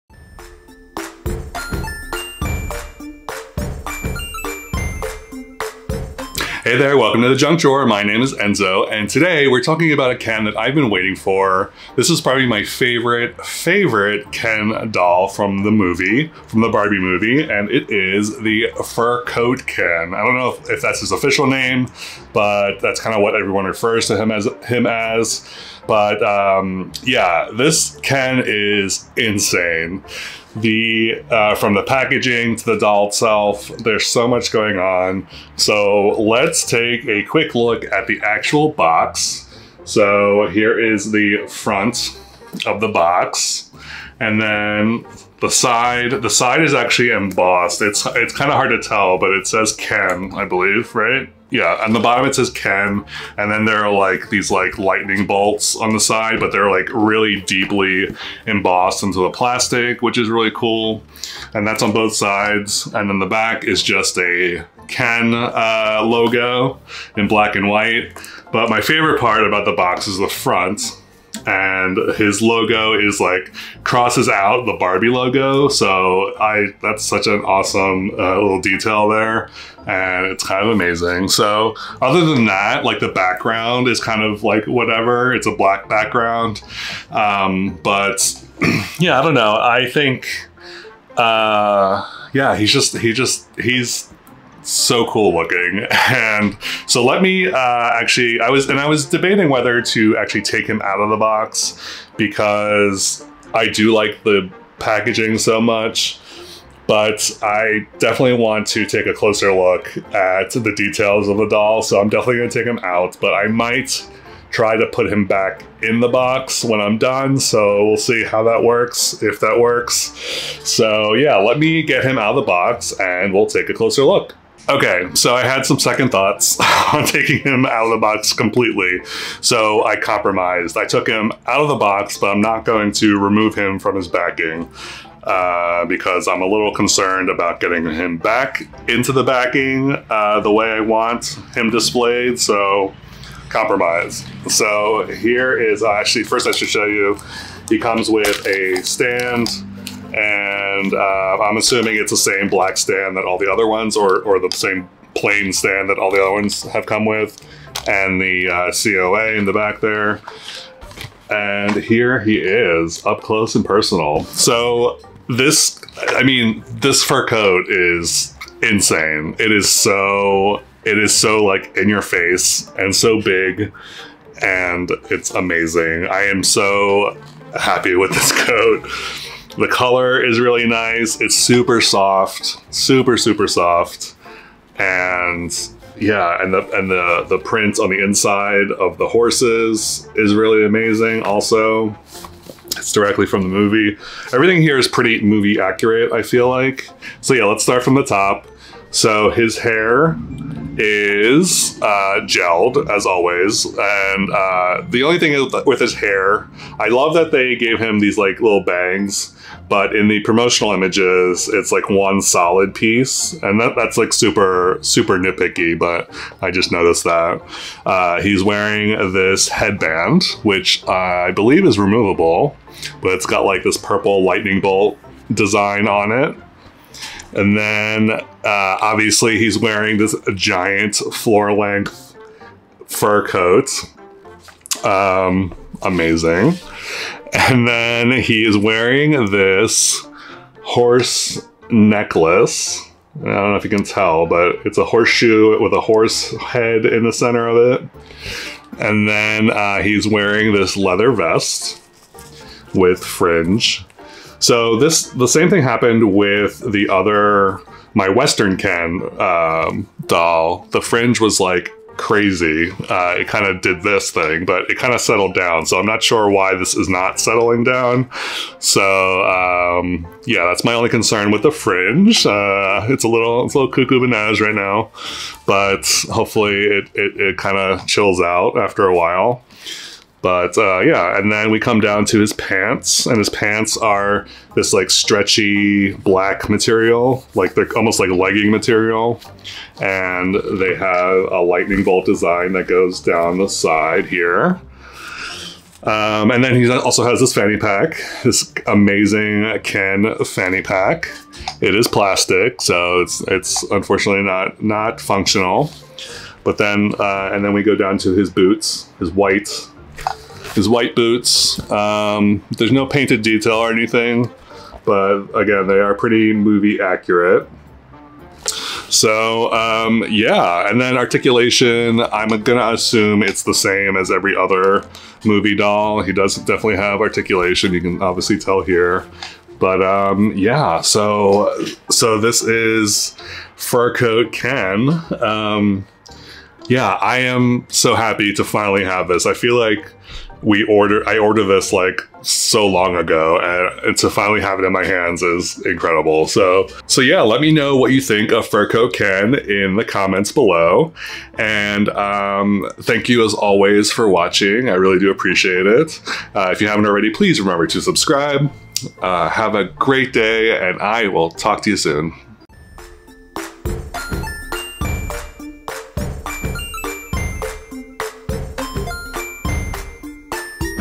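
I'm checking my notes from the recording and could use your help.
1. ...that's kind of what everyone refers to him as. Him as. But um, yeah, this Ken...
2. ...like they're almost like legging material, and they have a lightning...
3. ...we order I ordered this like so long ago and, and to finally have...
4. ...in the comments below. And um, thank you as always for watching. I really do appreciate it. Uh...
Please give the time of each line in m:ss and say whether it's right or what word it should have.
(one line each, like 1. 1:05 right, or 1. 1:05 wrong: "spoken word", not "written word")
1. 0:22 right
2. 4:47 right
3. 5:40 right
4. 5:49 right.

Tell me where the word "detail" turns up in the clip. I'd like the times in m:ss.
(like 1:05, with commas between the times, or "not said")
1:18, 1:50, 5:13.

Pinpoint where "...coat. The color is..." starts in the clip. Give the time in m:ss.
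2:58.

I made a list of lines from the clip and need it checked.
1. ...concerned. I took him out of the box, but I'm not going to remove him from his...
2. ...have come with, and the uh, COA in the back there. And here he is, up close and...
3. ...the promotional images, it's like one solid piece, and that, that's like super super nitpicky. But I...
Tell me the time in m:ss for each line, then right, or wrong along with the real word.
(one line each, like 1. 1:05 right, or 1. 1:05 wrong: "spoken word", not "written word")
1. 2:09 wrong: "compromised", not "concerned"
2. 2:36 right
3. 3:30 right.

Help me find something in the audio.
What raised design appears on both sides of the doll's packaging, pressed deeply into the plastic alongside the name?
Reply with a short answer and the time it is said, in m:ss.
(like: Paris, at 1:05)
lightning bolts, at 0:54.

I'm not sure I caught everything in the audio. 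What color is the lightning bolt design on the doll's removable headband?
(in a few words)
purple.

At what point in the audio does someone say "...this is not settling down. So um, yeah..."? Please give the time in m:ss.
4:26.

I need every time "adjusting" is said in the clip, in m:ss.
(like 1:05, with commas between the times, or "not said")
not said.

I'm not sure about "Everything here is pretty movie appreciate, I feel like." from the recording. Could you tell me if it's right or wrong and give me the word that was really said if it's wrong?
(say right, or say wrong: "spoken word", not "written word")
wrong: "accurate", not "appreciate".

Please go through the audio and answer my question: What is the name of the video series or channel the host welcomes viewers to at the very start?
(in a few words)
The Junk Drawer.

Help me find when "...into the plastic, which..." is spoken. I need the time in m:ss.
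0:59.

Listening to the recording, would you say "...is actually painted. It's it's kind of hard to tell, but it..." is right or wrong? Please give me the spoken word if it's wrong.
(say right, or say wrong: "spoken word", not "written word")
wrong: "embossed", not "painted".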